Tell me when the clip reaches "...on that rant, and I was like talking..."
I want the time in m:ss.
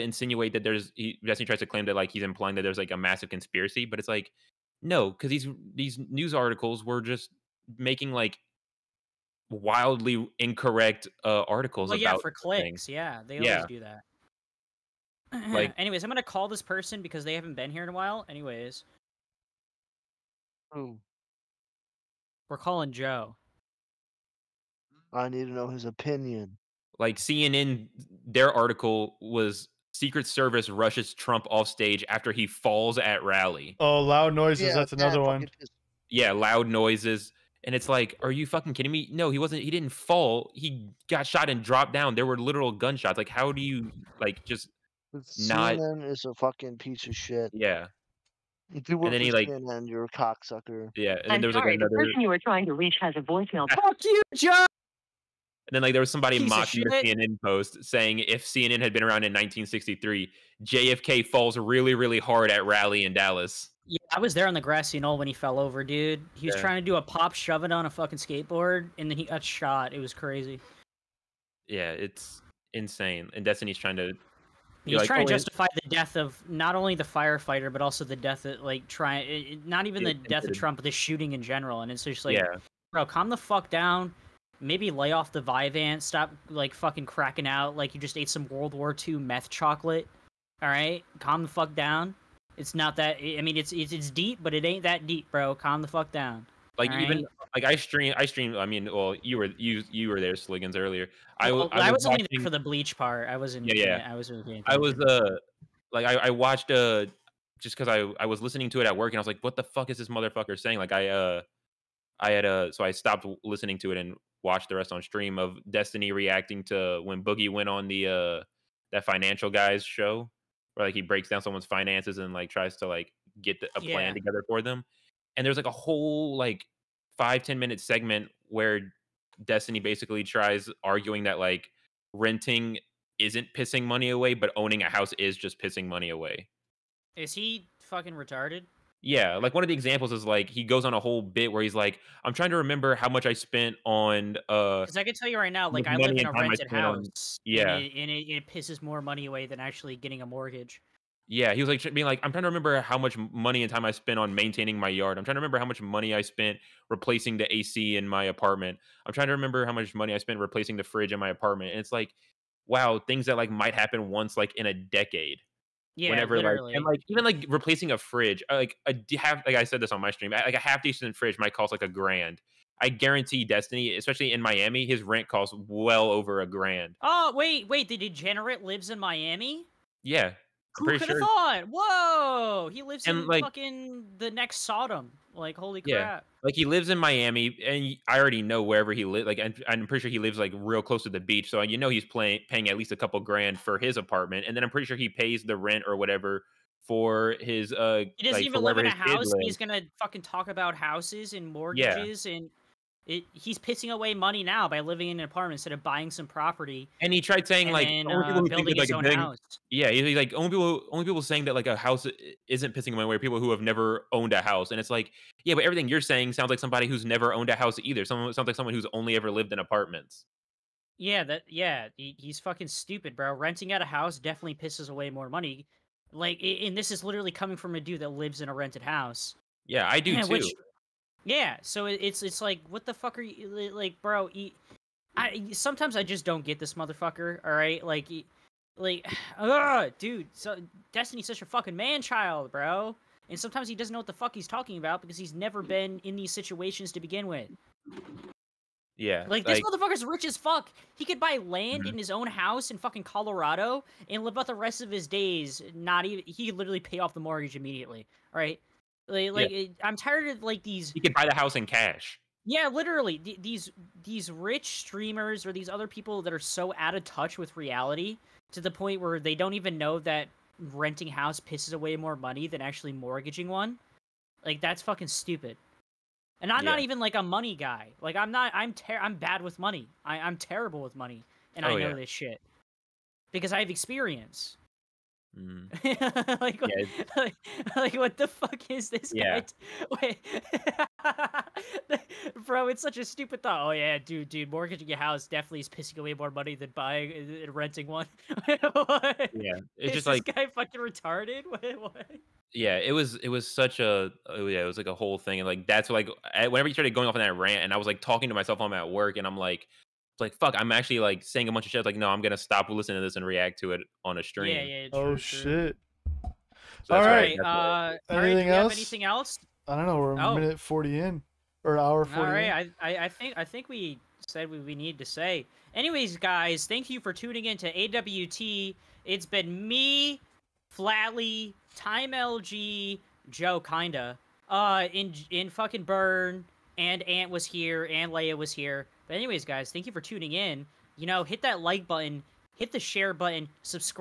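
5:07.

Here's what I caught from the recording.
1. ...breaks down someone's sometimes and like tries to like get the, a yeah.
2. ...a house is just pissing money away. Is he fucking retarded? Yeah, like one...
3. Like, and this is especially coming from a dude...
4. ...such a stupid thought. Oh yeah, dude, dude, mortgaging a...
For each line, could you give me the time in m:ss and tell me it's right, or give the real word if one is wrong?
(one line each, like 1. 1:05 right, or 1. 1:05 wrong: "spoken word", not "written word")
1. 2:01 wrong: "finances", not "sometimes"
2. 2:14 right
3. 3:46 wrong: "literally", not "especially"
4. 4:52 right.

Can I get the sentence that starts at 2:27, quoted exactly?
On, yeah, and, it, and it, it, pisses more money away than actually getting a mortgage.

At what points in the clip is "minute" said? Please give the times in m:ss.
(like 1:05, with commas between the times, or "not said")
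2:07, 5:20.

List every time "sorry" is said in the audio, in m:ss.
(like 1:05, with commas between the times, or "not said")
0:51.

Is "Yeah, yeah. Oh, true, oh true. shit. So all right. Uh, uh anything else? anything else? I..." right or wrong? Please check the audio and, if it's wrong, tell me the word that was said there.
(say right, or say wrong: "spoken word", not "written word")
right.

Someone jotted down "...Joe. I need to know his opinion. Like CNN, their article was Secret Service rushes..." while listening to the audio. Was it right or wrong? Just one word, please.
right.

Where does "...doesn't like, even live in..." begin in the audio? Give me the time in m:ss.
3:18.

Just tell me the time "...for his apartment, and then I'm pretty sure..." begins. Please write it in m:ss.
3:13.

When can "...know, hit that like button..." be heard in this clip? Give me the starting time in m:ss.
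5:41.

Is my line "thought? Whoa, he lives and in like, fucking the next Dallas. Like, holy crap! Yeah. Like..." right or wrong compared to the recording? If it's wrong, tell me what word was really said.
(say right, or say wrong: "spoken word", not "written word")
wrong: "Sodom", not "Dallas".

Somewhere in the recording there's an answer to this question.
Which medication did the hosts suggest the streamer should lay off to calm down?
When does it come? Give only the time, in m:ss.
1:25.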